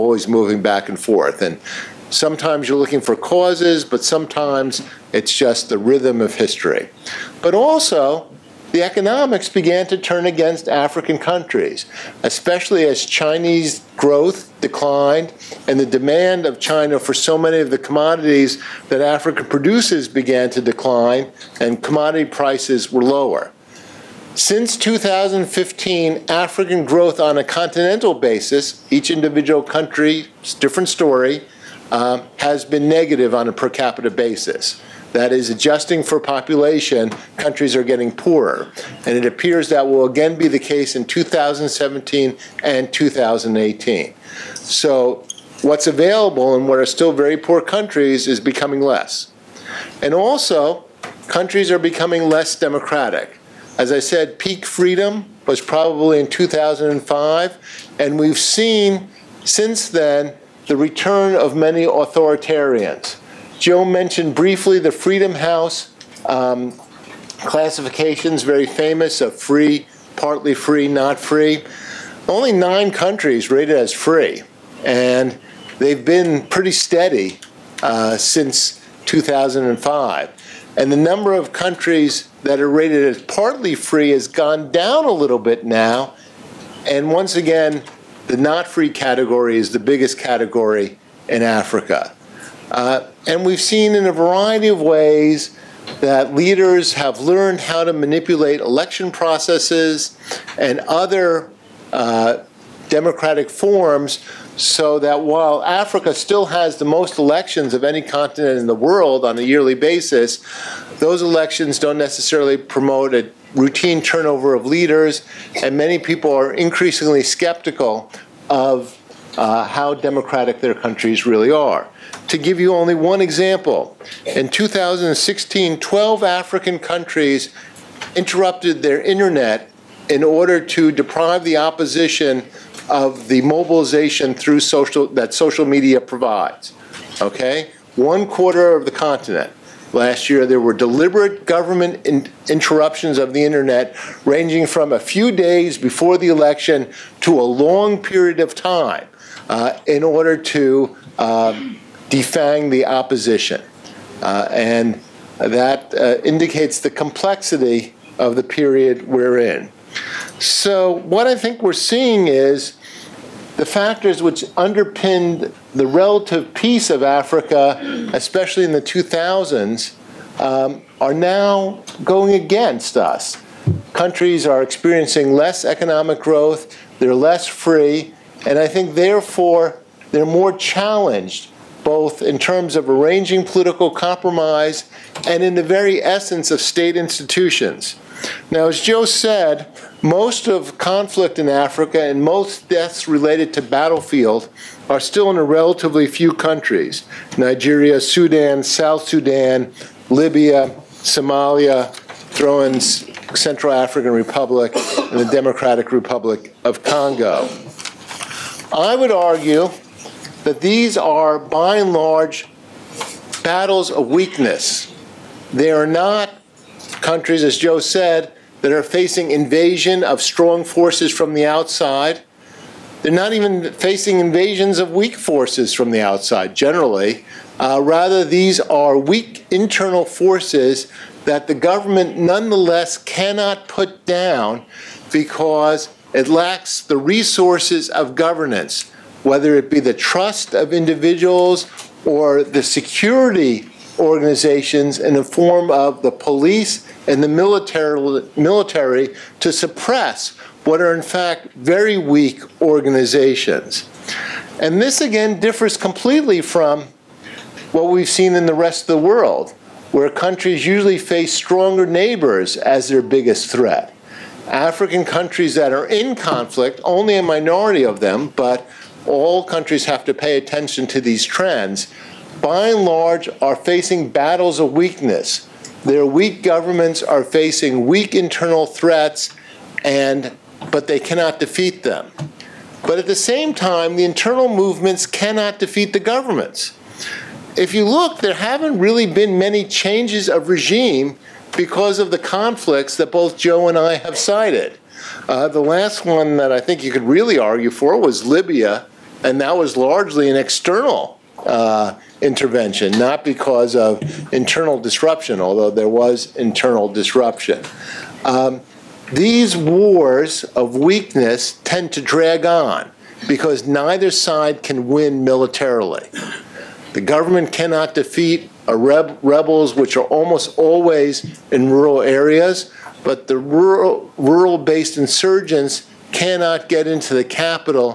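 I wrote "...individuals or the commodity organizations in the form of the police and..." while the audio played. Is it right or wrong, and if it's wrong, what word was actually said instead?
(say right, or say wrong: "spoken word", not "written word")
wrong: "security", not "commodity".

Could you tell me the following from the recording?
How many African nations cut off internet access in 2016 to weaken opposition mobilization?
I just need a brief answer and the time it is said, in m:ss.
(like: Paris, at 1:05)
12, at 2:05.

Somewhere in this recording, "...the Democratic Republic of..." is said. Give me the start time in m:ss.
3:25.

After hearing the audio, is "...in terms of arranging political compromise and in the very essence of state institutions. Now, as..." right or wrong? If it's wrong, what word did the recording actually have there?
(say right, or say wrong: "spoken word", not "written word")
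right.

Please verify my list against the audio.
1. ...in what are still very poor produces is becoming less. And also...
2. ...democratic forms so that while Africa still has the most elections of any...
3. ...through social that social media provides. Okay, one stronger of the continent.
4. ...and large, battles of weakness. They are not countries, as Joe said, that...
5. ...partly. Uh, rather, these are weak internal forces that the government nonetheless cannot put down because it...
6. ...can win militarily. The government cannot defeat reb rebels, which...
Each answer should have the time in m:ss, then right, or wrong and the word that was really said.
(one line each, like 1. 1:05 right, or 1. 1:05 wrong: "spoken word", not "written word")
1. 0:46 wrong: "countries", not "produces"
2. 1:42 right
3. 2:14 wrong: "quarter", not "stronger"
4. 3:31 right
5. 3:46 wrong: "generally", not "partly"
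6. 5:14 right.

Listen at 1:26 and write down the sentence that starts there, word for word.
And once again, the not free category is the biggest category in Africa.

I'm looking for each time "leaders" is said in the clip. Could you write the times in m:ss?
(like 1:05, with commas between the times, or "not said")
1:36, 1:54.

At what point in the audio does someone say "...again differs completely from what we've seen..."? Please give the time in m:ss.
4:15.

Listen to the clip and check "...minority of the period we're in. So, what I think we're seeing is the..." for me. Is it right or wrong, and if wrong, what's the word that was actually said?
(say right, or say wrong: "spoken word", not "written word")
wrong: "complexity", not "minority".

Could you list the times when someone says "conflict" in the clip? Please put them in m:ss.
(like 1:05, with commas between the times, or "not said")
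3:10, 4:26, 4:52.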